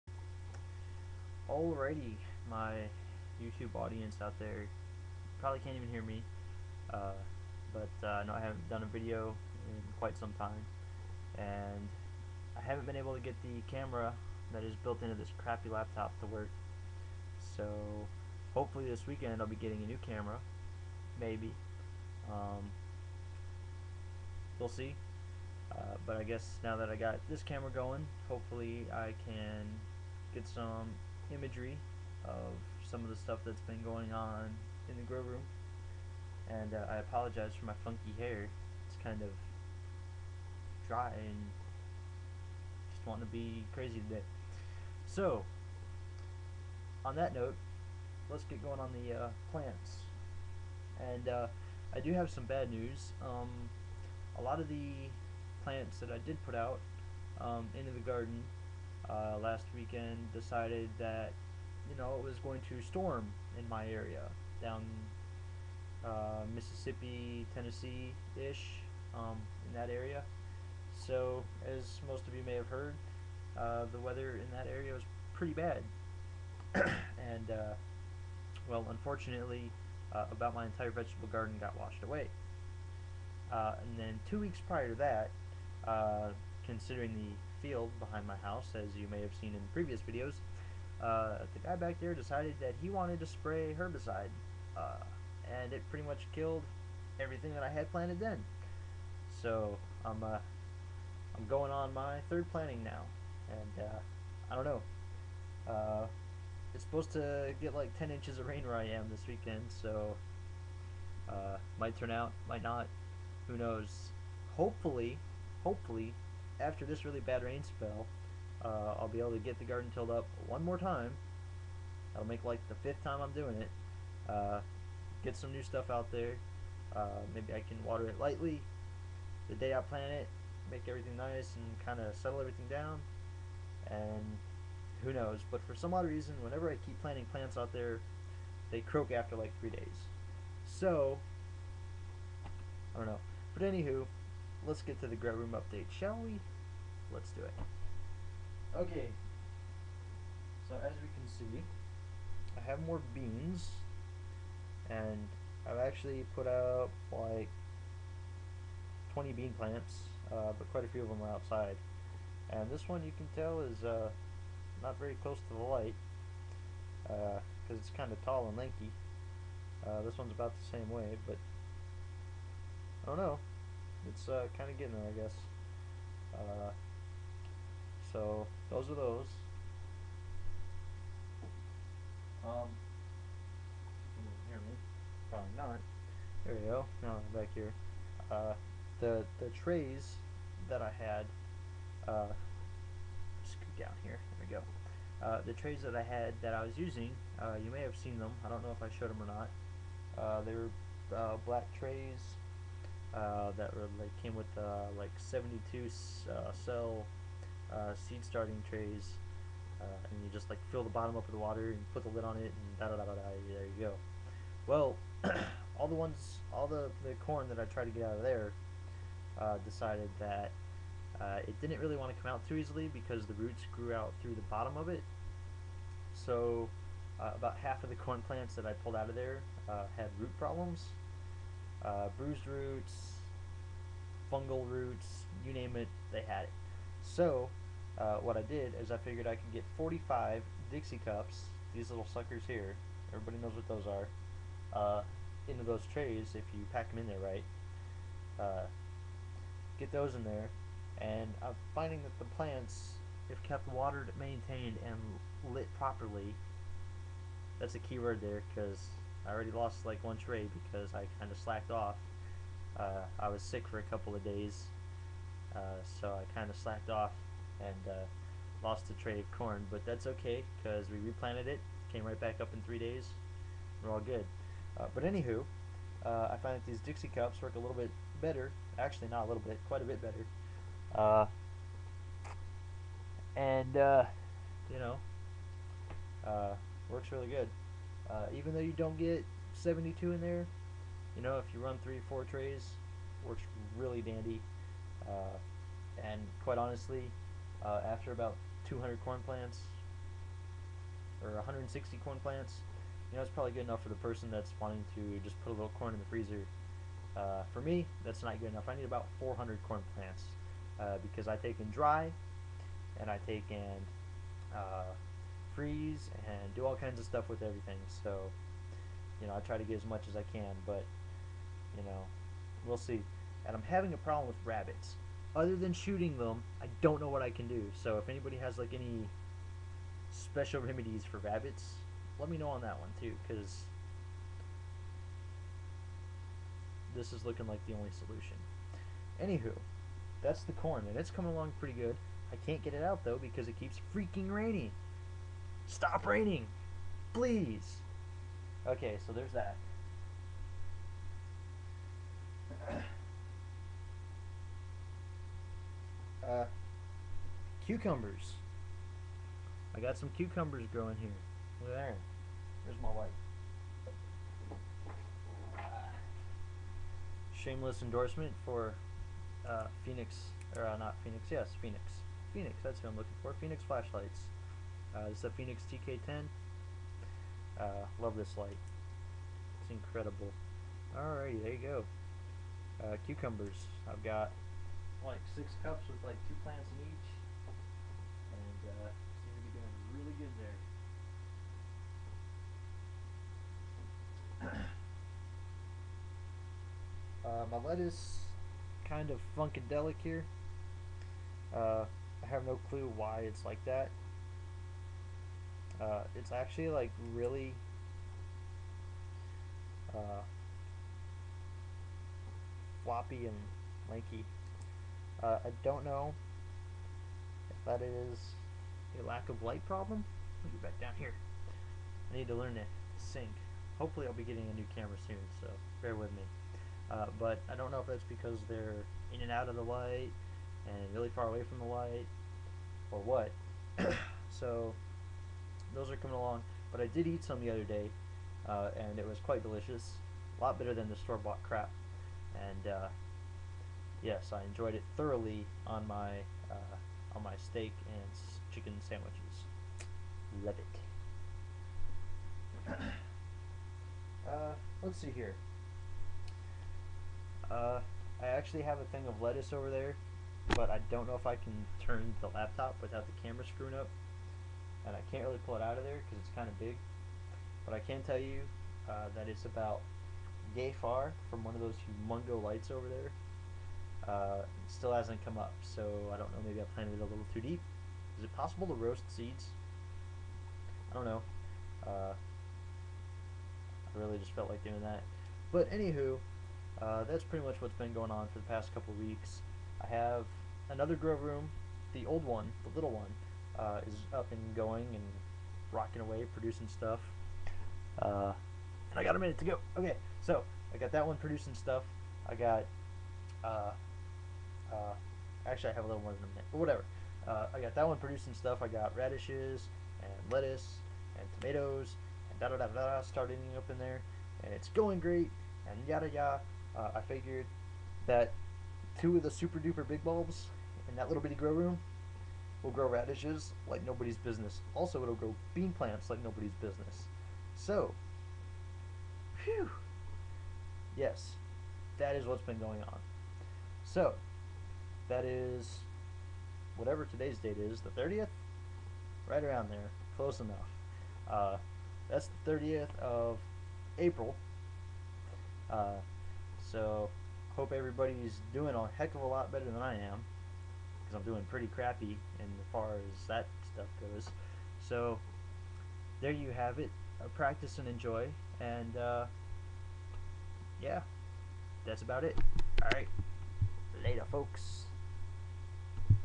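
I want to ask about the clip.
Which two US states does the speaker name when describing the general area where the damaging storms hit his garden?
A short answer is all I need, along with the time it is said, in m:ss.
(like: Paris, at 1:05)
Mississippi, Tennessee, at 1:06.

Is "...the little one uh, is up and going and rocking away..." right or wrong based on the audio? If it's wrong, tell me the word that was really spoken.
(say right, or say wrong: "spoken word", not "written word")
right.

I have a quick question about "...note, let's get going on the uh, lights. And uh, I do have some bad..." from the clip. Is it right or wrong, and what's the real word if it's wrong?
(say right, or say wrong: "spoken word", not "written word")
wrong: "plants", not "lights".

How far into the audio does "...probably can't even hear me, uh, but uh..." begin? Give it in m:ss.
0:05.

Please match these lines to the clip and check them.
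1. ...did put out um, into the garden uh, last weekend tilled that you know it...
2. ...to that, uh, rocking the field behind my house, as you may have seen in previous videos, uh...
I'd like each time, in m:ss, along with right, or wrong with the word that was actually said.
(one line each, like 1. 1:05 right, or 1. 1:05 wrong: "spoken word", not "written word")
1. 0:56 wrong: "decided", not "tilled"
2. 1:24 wrong: "considering", not "rocking".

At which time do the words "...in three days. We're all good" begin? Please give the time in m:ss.
4:32.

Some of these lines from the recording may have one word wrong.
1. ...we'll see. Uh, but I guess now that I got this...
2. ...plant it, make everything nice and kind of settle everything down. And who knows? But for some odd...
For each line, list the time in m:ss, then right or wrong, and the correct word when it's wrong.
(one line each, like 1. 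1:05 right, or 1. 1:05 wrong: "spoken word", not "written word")
1. 0:24 right
2. 2:09 right.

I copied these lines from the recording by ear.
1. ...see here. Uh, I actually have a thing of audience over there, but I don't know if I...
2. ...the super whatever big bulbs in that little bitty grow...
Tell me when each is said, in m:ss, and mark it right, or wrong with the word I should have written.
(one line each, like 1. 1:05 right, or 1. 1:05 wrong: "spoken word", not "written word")
1. 7:35 wrong: "lettuce", not "audience"
2. 8:39 wrong: "duper", not "whatever".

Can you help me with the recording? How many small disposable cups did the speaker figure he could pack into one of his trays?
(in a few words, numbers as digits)
45.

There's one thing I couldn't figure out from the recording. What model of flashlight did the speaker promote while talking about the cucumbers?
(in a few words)
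Fenix TK10.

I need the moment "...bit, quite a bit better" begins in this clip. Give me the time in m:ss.
4:39.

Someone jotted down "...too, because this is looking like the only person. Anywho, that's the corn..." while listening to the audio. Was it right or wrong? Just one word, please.
wrong.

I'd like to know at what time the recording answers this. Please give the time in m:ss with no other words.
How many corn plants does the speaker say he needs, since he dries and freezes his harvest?
5:09.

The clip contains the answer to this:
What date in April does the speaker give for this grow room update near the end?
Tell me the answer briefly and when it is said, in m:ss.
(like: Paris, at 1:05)
30th, at 9:02.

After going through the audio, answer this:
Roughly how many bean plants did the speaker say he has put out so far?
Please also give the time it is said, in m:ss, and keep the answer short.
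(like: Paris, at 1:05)
20, at 2:39.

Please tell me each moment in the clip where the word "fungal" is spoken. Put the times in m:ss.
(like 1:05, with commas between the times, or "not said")
3:54.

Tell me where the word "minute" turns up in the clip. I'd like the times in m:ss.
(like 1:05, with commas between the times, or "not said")
8:19, 8:26.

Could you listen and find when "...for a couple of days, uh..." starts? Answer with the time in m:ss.
4:23.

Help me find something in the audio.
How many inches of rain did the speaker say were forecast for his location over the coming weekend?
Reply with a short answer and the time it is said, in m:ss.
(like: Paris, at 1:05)
10, at 1:47.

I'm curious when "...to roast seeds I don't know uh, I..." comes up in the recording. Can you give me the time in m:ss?
7:58.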